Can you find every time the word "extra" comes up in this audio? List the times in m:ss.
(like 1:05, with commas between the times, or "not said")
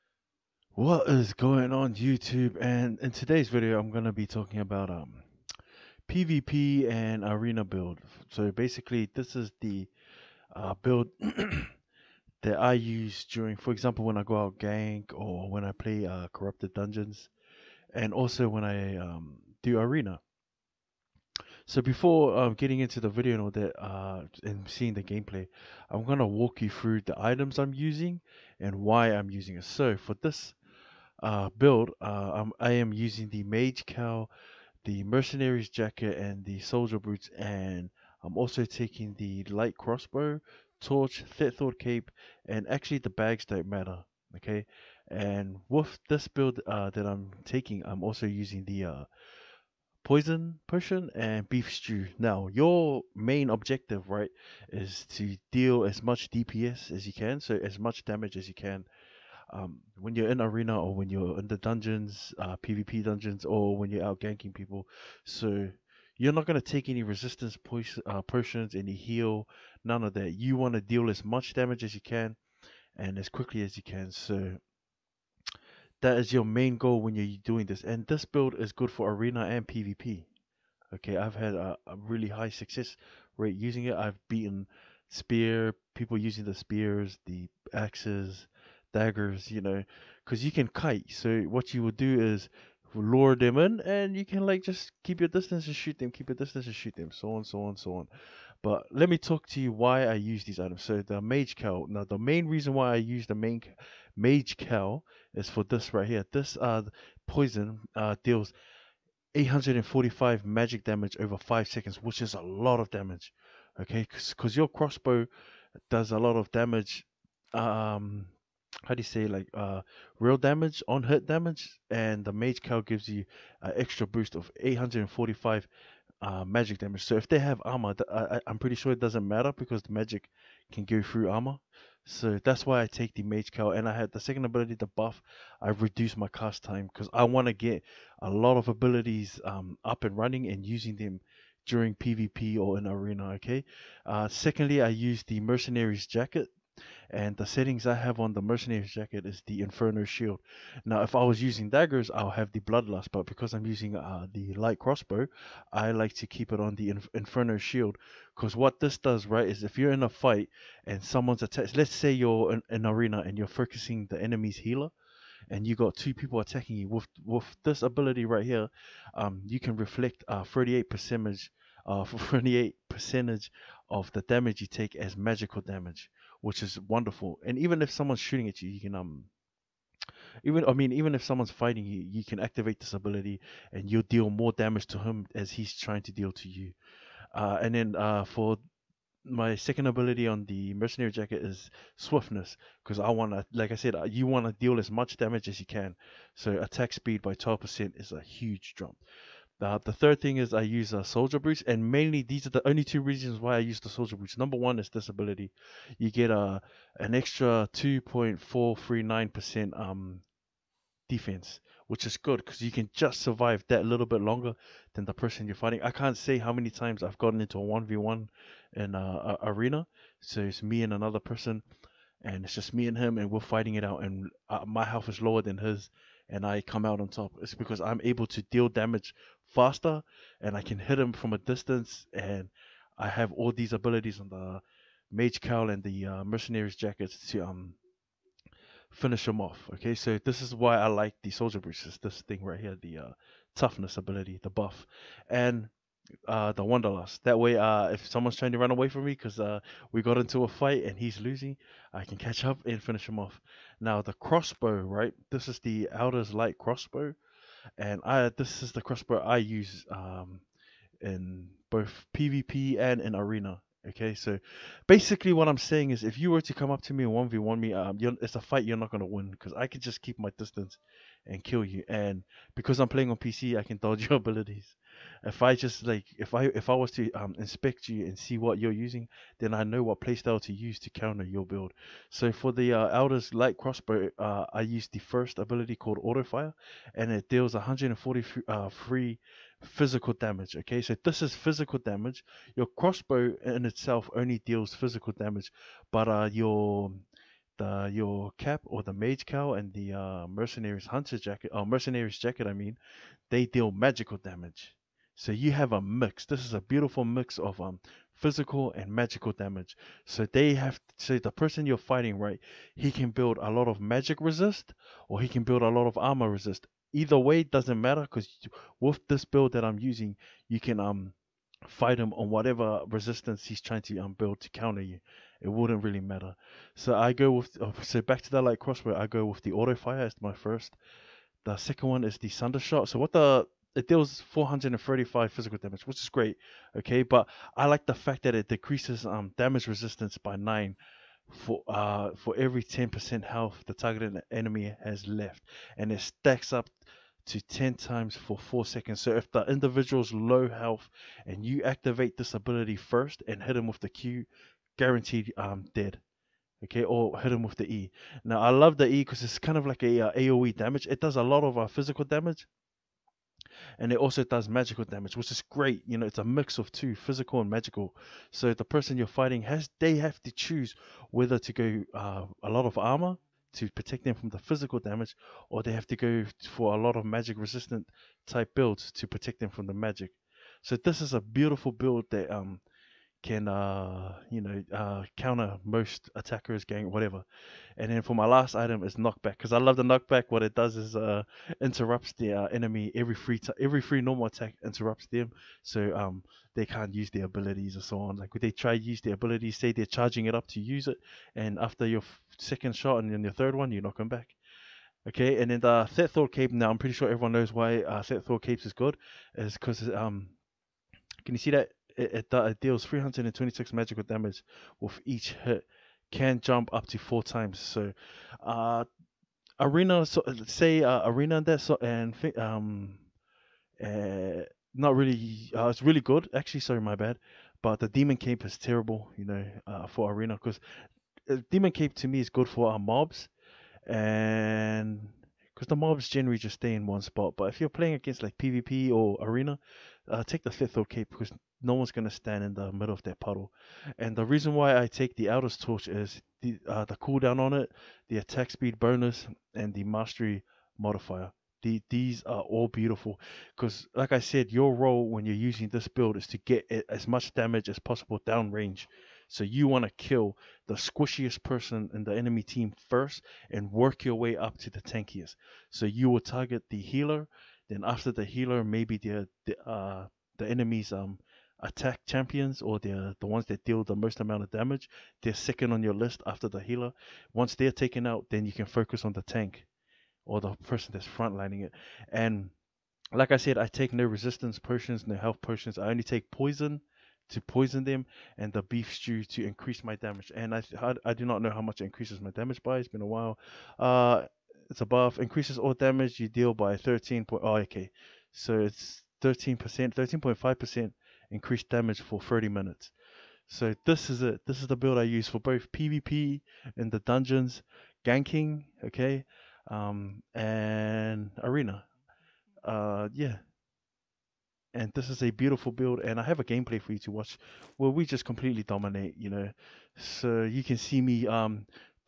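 2:03, 3:27.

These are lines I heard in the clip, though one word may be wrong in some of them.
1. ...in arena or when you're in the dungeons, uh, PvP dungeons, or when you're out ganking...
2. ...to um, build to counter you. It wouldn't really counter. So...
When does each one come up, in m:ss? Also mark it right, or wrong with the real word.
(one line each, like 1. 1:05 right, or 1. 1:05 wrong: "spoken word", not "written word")
1. 1:00 right
2. 5:23 wrong: "matter", not "counter".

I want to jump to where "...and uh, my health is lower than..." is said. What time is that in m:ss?
3:44.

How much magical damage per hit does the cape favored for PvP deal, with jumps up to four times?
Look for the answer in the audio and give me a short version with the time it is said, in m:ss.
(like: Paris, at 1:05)
326, at 6:52.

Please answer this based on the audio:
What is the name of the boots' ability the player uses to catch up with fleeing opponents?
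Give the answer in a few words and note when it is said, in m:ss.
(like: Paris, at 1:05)
Wanderlust, at 4:06.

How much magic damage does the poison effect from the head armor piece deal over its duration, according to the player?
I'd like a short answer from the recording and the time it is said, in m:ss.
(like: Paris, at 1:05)
845, at 1:46.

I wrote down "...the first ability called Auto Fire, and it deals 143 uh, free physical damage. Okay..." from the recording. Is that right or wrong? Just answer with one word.
right.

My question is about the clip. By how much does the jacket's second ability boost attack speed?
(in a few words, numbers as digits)
12%.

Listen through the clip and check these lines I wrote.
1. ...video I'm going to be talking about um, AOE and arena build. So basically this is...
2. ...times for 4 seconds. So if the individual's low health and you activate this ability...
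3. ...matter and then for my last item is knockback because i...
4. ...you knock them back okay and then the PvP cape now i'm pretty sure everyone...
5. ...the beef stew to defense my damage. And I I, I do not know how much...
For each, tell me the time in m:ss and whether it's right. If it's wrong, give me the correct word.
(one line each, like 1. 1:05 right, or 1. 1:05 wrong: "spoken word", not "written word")
1. 0:03 wrong: "PvP", not "AOE"
2. 5:47 right
3. 6:26 wrong: "whatever", not "matter"
4. 6:43 wrong: "Thetford", not "PvP"
5. 8:08 wrong: "increase", not "defense".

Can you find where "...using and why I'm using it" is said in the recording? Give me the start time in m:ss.
0:27.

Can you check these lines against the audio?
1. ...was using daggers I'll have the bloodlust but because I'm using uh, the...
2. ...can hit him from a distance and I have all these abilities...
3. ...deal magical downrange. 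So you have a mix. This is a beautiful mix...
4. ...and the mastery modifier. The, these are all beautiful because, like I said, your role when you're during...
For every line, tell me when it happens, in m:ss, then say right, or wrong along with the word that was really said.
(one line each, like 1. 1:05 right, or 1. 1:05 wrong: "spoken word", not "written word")
1. 2:31 right
2. 3:50 right
3. 5:03 wrong: "damage", not "downrange"
4. 7:29 wrong: "using", not "during".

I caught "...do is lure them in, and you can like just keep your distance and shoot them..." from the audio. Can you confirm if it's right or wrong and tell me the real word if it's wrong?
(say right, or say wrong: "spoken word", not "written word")
right.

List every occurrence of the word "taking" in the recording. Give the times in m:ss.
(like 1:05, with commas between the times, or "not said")
0:38, 0:47.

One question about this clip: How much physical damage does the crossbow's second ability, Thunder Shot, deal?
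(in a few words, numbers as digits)
435.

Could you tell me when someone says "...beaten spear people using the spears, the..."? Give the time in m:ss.
1:24.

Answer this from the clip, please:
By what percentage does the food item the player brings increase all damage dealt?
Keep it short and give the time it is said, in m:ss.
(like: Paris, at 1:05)
13.5%, at 8:19.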